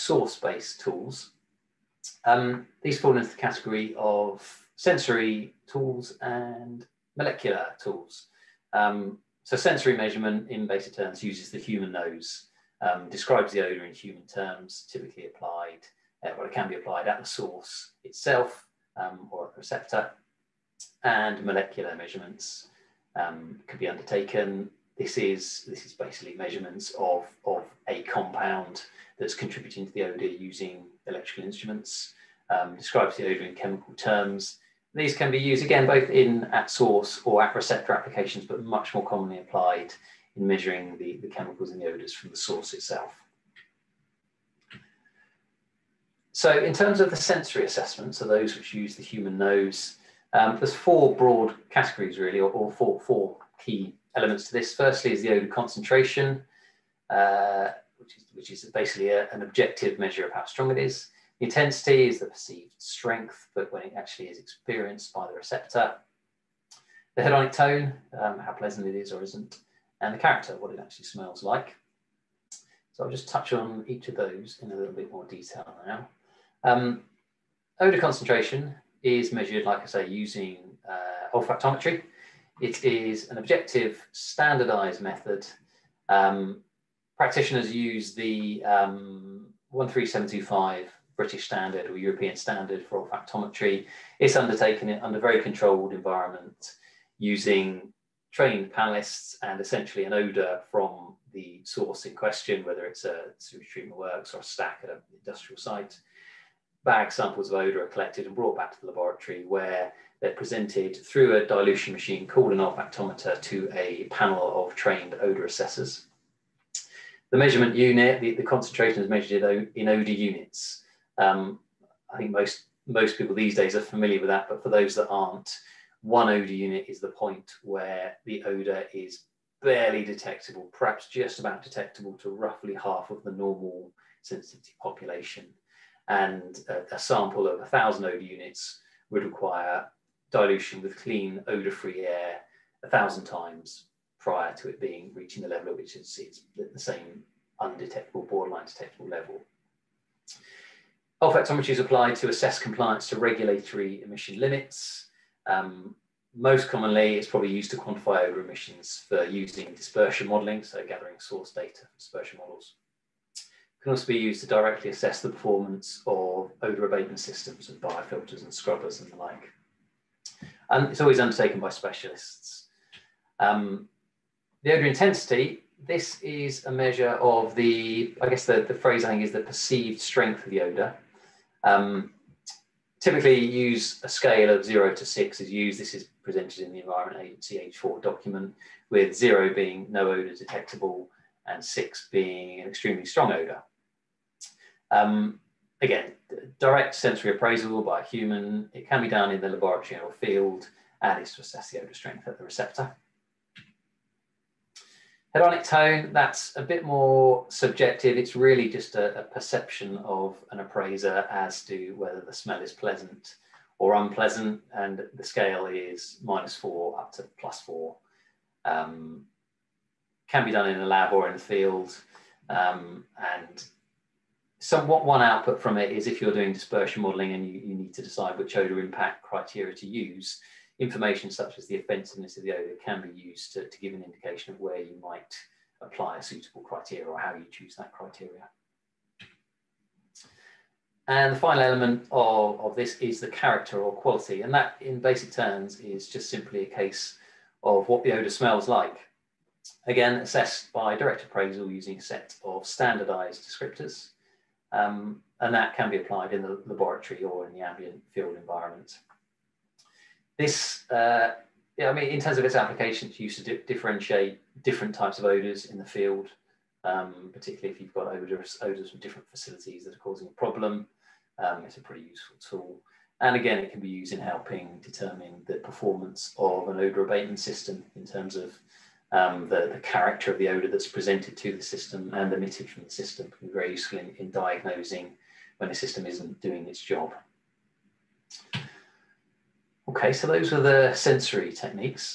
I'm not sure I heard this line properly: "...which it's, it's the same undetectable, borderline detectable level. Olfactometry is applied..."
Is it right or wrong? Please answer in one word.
right.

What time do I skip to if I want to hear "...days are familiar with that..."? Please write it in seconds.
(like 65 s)
123 s.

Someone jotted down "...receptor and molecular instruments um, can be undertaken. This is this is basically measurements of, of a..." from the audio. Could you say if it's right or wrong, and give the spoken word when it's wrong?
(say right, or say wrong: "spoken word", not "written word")
wrong: "measurements", not "instruments".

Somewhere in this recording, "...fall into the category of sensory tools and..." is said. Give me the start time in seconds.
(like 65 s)
3 s.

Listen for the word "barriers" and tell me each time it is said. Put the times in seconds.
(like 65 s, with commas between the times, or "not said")
not said.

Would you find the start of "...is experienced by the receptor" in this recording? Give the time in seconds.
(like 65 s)
64 s.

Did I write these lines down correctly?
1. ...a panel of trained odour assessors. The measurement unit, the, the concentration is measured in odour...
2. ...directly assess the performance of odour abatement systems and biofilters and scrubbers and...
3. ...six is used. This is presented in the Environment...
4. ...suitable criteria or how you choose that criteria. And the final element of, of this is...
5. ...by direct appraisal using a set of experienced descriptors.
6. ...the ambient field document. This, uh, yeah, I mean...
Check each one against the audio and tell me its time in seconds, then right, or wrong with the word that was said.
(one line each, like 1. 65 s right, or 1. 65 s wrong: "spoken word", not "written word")
1. 113 s right
2. 164 s right
3. 185 s right
4. 236 s right
5. 250 s wrong: "standardized", not "experienced"
6. 257 s wrong: "environment", not "document".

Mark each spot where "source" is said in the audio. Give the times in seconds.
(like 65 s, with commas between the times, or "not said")
17 s, 36 s, 42 s, 101 s, 161 s.